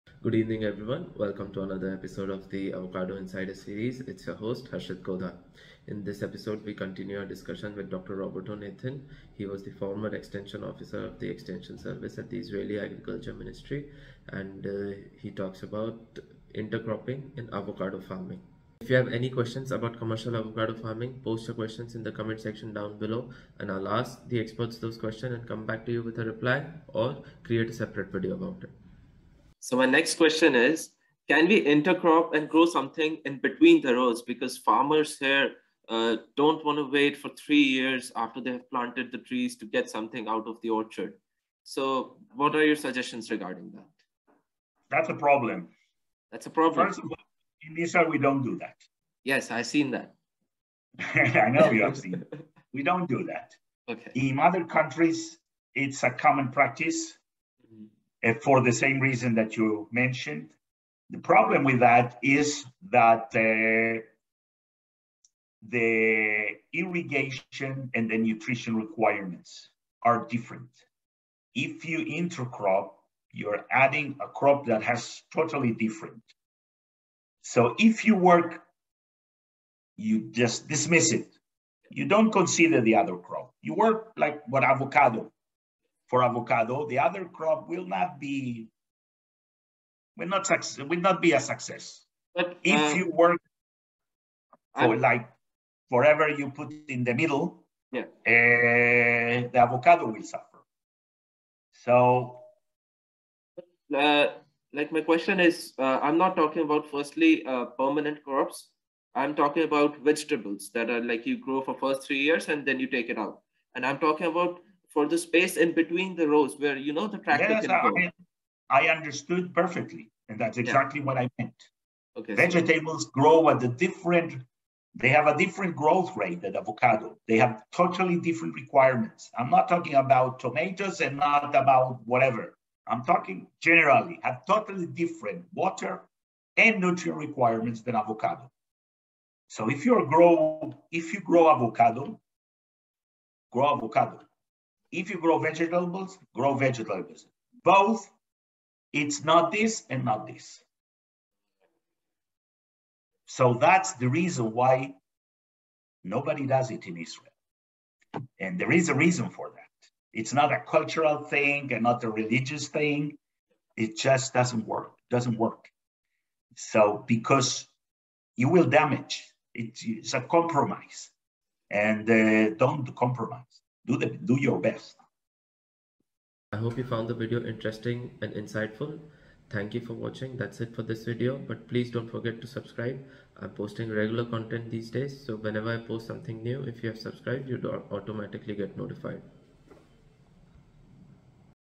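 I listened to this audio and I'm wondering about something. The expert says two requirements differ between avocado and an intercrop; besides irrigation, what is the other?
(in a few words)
Nutrition.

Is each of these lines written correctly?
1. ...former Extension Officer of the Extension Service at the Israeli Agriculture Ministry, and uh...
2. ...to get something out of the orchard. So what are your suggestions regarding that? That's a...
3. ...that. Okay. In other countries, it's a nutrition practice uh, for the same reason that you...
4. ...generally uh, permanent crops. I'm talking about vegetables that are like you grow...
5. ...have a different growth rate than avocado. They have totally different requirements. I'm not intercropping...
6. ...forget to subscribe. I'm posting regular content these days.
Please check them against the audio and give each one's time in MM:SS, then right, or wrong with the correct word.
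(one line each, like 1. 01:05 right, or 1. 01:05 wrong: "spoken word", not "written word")
1. 00:09 right
2. 00:39 right
3. 00:53 wrong: "common", not "nutrition"
4. 01:46 wrong: "firstly", not "generally"
5. 02:05 wrong: "talking", not "intercropping"
6. 03:02 right.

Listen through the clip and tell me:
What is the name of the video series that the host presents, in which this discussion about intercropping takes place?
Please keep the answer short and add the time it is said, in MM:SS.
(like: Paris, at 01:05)
Avocado Insider, at 00:02.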